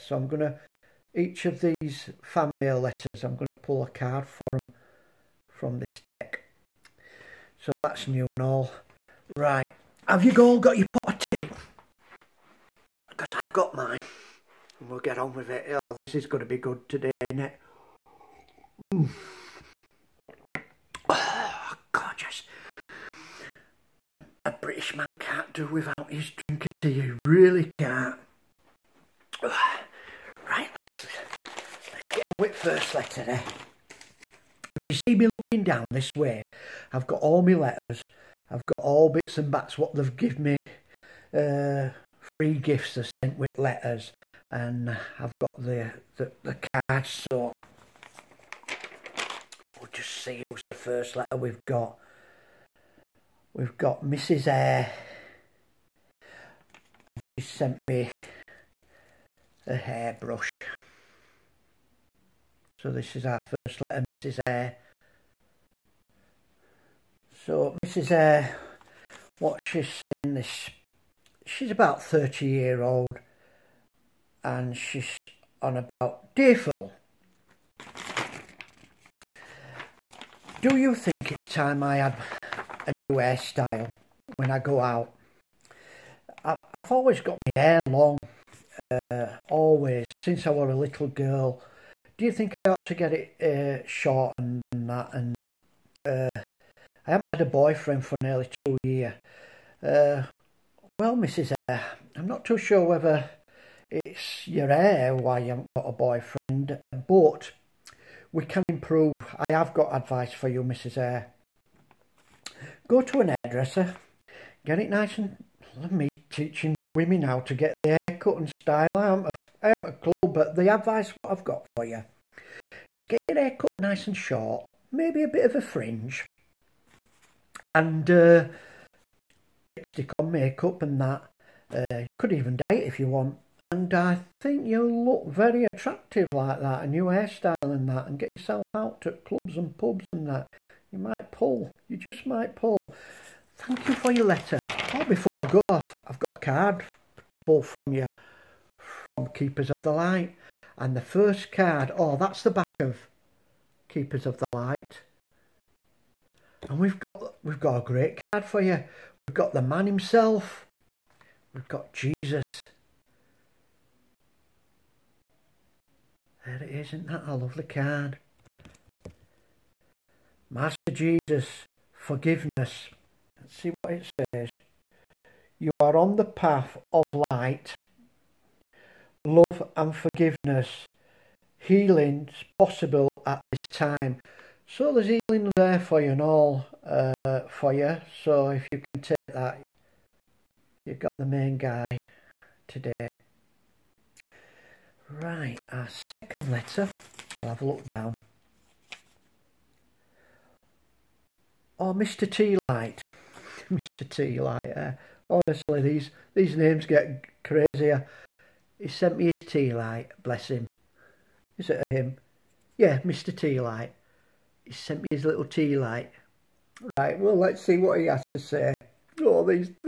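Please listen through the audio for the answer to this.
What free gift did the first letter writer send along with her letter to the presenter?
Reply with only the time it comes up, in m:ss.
0:59.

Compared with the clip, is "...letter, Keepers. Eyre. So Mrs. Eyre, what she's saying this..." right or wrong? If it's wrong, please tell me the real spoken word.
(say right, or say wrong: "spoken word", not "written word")
wrong: "Mrs", not "Keepers".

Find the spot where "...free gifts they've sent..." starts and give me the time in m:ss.
0:42.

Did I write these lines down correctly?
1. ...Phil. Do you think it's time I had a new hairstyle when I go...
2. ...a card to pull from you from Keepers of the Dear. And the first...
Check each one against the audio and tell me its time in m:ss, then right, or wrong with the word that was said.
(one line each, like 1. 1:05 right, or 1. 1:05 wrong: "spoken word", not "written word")
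1. 1:16 right
2. 2:26 wrong: "Light", not "Dear".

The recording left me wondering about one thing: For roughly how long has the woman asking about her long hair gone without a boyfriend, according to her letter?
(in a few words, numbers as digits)
nearly 2 years.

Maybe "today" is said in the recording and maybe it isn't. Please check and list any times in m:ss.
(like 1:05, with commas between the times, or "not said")
0:16, 0:33, 3:12.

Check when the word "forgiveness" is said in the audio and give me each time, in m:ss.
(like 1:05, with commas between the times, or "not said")
2:51, 2:59.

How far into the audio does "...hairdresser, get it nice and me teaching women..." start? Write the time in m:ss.
1:53.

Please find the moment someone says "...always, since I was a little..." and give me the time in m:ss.
1:29.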